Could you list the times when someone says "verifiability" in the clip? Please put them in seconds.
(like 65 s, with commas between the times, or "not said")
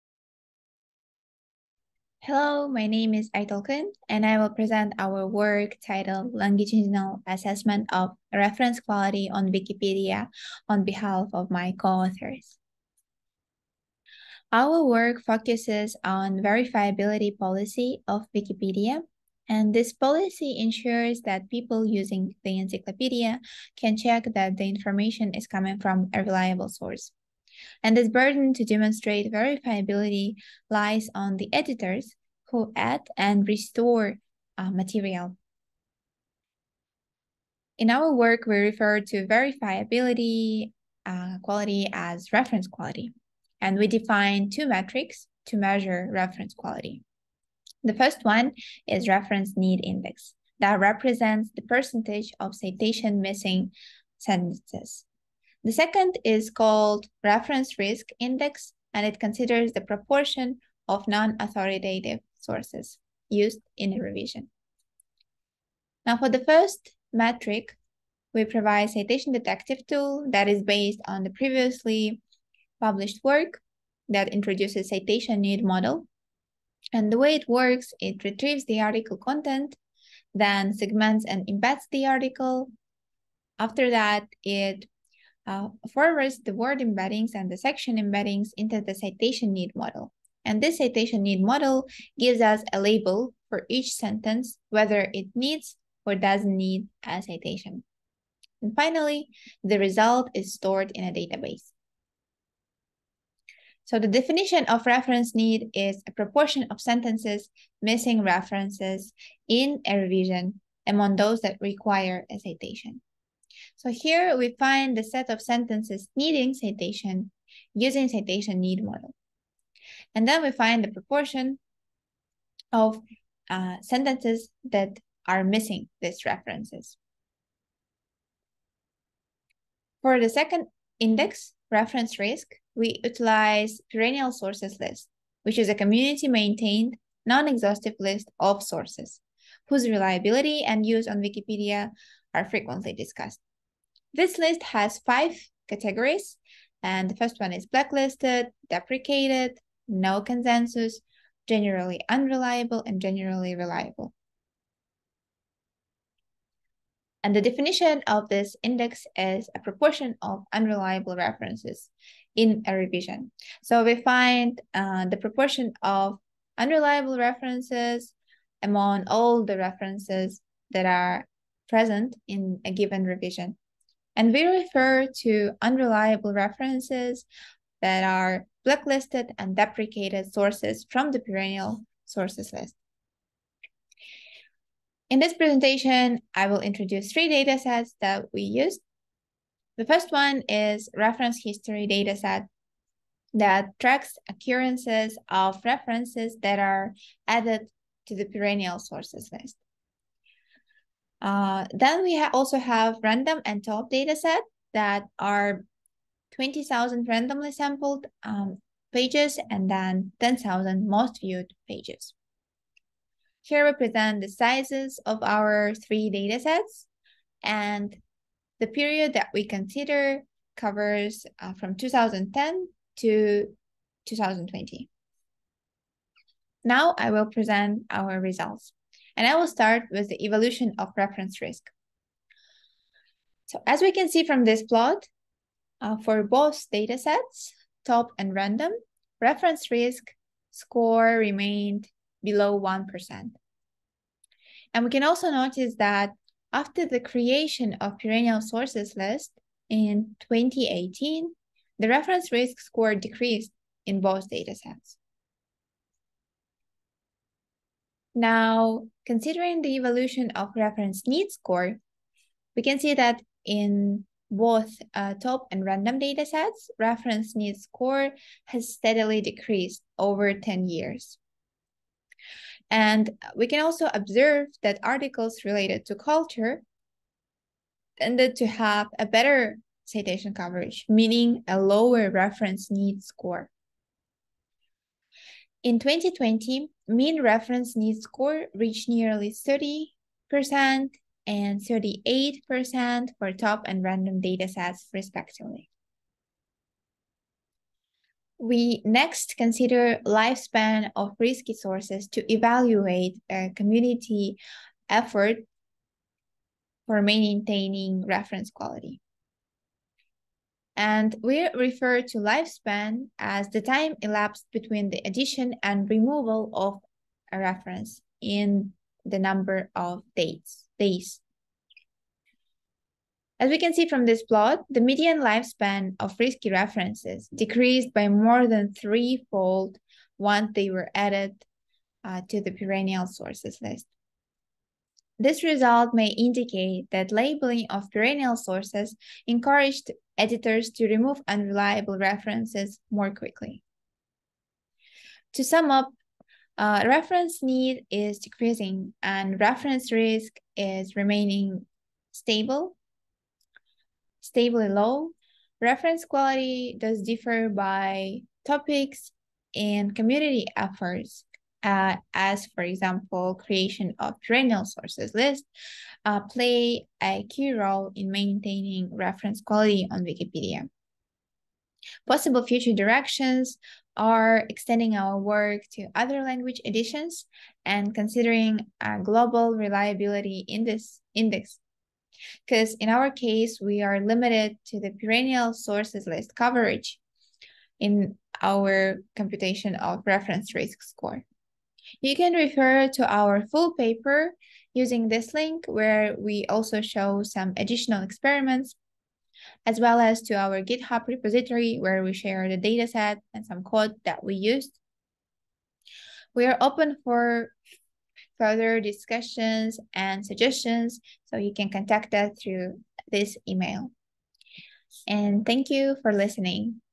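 16 s, 29 s, 39 s.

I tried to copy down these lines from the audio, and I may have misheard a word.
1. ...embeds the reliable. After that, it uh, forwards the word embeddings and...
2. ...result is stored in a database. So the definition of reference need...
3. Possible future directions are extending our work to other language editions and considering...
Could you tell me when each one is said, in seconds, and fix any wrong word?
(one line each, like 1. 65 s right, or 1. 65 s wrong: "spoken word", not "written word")
1. 81 s wrong: "article", not "reliable"
2. 99 s right
3. 372 s right.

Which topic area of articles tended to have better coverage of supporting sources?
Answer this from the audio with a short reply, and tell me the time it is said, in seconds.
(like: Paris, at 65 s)
culture, at 275 s.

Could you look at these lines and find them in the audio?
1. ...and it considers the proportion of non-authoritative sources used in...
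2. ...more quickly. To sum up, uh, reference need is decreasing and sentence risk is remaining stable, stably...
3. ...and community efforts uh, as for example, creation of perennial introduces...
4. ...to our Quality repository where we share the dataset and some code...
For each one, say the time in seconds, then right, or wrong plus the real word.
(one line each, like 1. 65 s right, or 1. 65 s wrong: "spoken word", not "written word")
1. 58 s right
2. 342 s wrong: "reference", not "sentence"
3. 359 s wrong: "sources", not "introduces"
4. 400 s wrong: "GitHub", not "Quality".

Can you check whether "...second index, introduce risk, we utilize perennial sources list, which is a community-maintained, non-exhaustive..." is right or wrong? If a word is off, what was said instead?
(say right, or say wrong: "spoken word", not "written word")
wrong: "reference", not "introduce".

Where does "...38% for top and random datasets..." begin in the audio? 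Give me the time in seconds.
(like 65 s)
291 s.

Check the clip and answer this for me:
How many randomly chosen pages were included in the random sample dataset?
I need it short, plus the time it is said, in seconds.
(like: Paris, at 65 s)
20,000, at 206 s.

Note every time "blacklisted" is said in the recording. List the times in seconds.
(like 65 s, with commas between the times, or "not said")
147 s, 178 s.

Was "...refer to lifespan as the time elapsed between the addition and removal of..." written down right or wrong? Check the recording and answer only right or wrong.
right.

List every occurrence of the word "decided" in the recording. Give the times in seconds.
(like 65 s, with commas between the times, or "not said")
not said.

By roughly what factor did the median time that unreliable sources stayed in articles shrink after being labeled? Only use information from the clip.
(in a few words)
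more than threefold.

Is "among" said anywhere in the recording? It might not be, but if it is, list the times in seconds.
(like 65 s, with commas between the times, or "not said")
110 s, 168 s.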